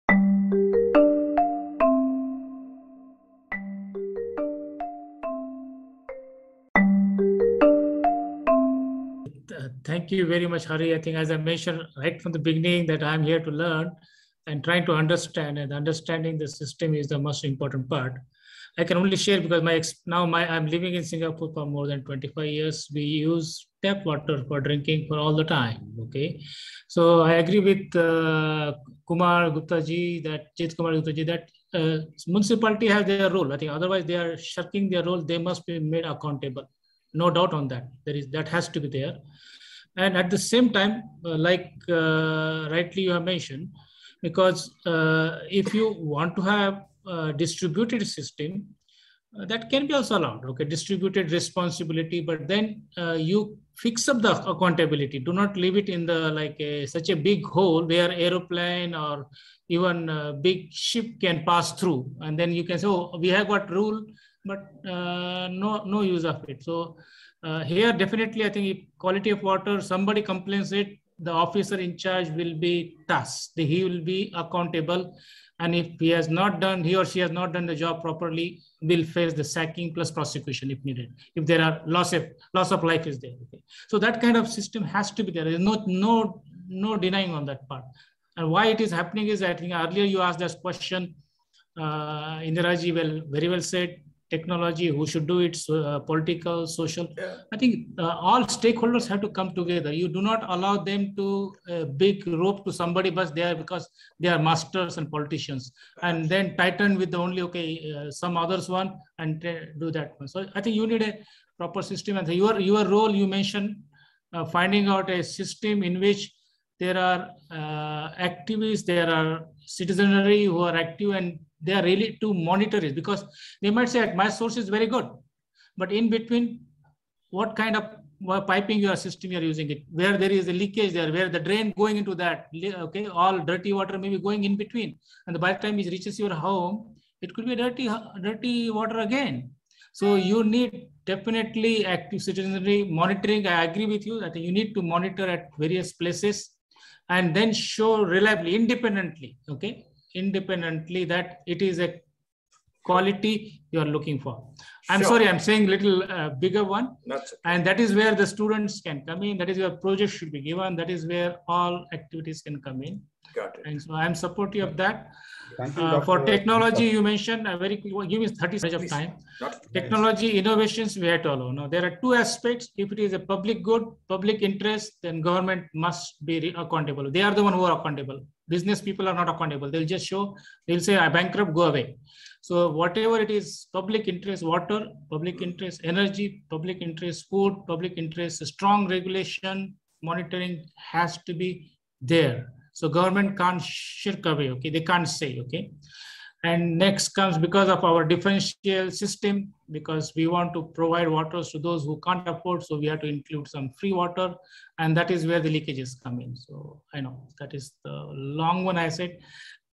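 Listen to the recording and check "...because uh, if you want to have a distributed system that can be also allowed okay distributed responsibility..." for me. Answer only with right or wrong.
right.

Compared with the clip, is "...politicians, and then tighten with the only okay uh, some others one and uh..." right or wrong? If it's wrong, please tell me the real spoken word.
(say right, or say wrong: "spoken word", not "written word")
right.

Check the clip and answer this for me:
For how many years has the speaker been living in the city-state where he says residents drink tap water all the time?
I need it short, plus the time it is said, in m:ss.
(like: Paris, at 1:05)
More than 25 years, at 0:21.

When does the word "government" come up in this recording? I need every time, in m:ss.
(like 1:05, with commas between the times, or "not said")
2:55, 3:12.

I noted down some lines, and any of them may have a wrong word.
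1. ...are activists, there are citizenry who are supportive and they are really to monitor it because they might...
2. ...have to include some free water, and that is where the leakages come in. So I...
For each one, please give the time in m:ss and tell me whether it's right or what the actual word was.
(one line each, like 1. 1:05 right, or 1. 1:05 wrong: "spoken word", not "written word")
1. 1:56 wrong: "active", not "supportive"
2. 3:22 right.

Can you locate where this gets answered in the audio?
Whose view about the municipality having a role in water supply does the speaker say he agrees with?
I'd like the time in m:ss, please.
0:30.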